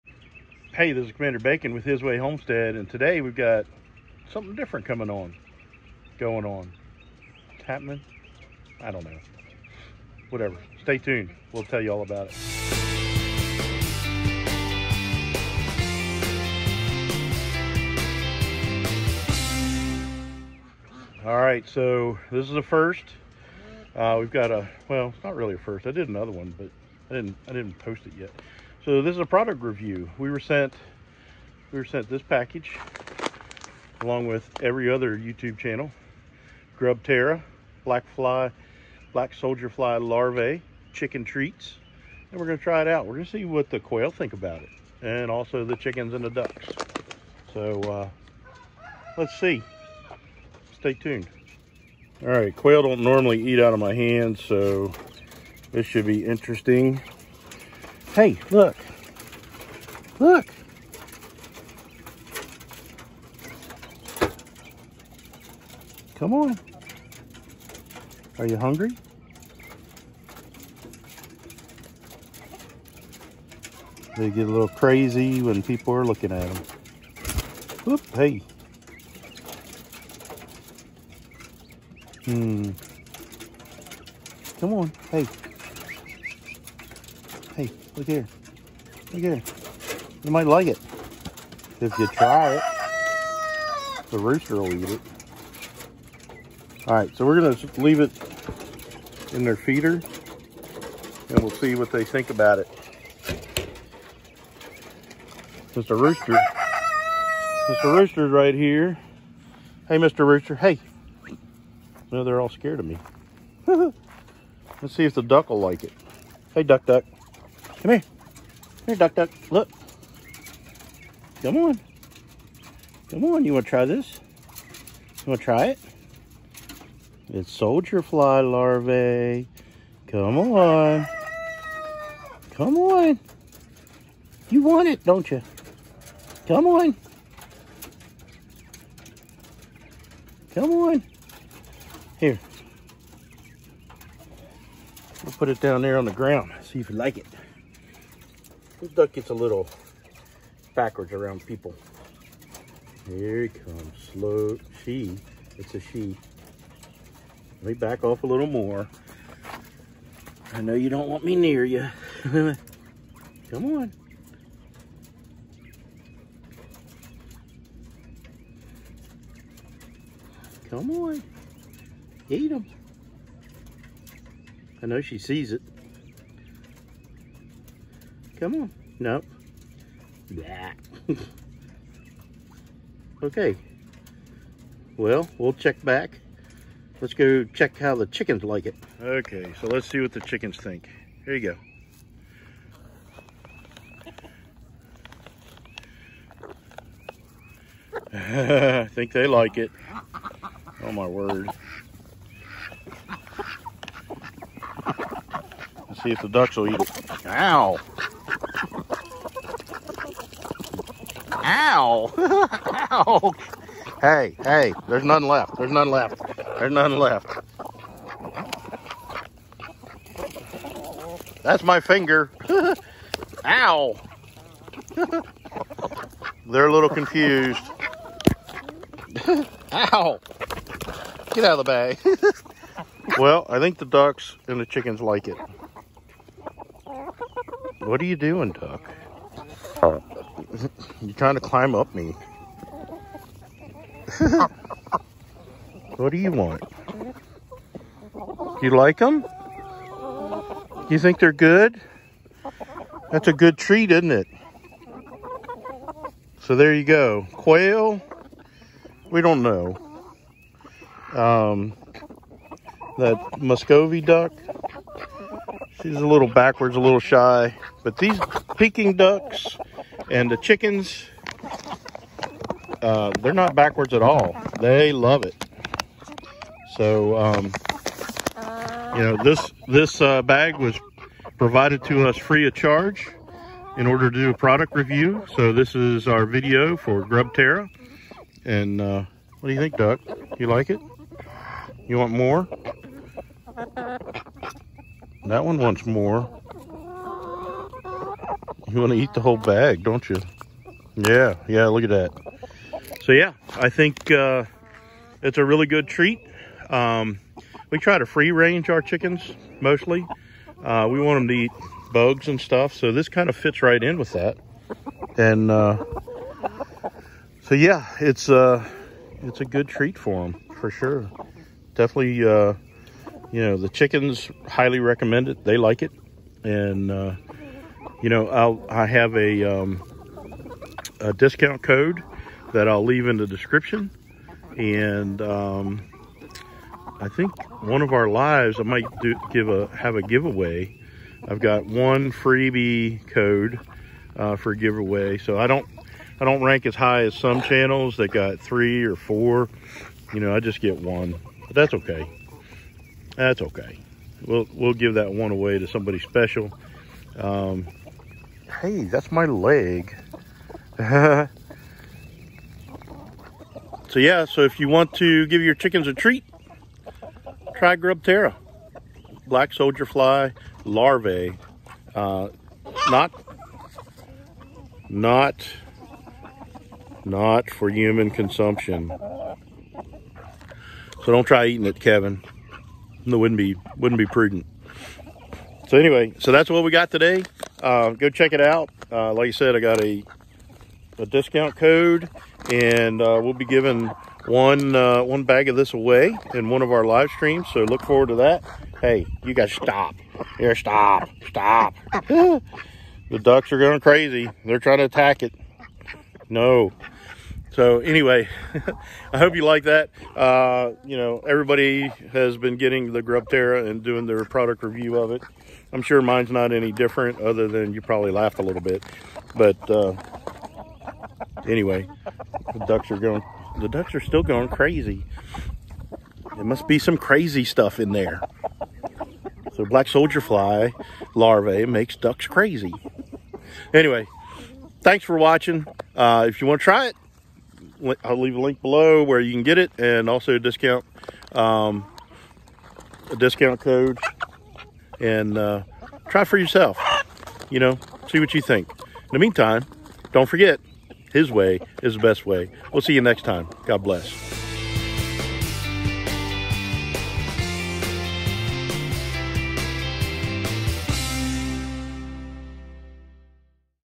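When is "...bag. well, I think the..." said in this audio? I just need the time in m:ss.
3:51.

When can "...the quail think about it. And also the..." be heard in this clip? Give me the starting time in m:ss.
0:43.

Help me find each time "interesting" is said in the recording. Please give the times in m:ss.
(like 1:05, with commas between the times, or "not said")
0:56.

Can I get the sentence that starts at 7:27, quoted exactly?
You know, see what you think.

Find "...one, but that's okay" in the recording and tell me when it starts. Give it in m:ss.
5:50.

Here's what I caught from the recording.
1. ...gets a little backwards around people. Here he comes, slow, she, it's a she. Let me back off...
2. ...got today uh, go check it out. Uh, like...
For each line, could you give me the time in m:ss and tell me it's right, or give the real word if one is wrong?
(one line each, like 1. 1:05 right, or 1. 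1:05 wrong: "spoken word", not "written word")
1. 2:29 right
2. 6:26 right.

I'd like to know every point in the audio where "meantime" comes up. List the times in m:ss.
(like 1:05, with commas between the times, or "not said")
7:29.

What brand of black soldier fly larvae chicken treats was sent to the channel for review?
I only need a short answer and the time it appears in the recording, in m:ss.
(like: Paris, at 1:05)
Grub Terra, at 0:36.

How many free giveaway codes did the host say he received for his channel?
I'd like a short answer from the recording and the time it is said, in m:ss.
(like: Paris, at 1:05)
1, at 5:41.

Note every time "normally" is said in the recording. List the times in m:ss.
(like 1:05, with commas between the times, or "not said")
0:53.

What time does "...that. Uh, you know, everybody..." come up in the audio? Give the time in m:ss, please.
6:49.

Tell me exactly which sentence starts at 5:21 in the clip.
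Definitely, uh, you know, the chickens highly recommend it.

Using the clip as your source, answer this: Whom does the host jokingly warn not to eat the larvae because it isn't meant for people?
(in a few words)
Kevin.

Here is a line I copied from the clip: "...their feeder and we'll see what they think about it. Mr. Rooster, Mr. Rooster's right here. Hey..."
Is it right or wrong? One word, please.
right.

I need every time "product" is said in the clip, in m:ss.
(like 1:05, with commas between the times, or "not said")
0:29, 4:44, 6:54.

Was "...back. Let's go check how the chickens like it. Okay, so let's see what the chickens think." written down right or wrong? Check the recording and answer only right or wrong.
right.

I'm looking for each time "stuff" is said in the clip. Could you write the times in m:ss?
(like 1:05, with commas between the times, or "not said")
5:12, 7:07.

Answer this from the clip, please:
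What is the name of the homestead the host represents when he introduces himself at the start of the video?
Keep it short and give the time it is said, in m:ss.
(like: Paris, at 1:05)
His Way Homestead, at 0:01.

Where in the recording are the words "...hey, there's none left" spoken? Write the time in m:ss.
3:34.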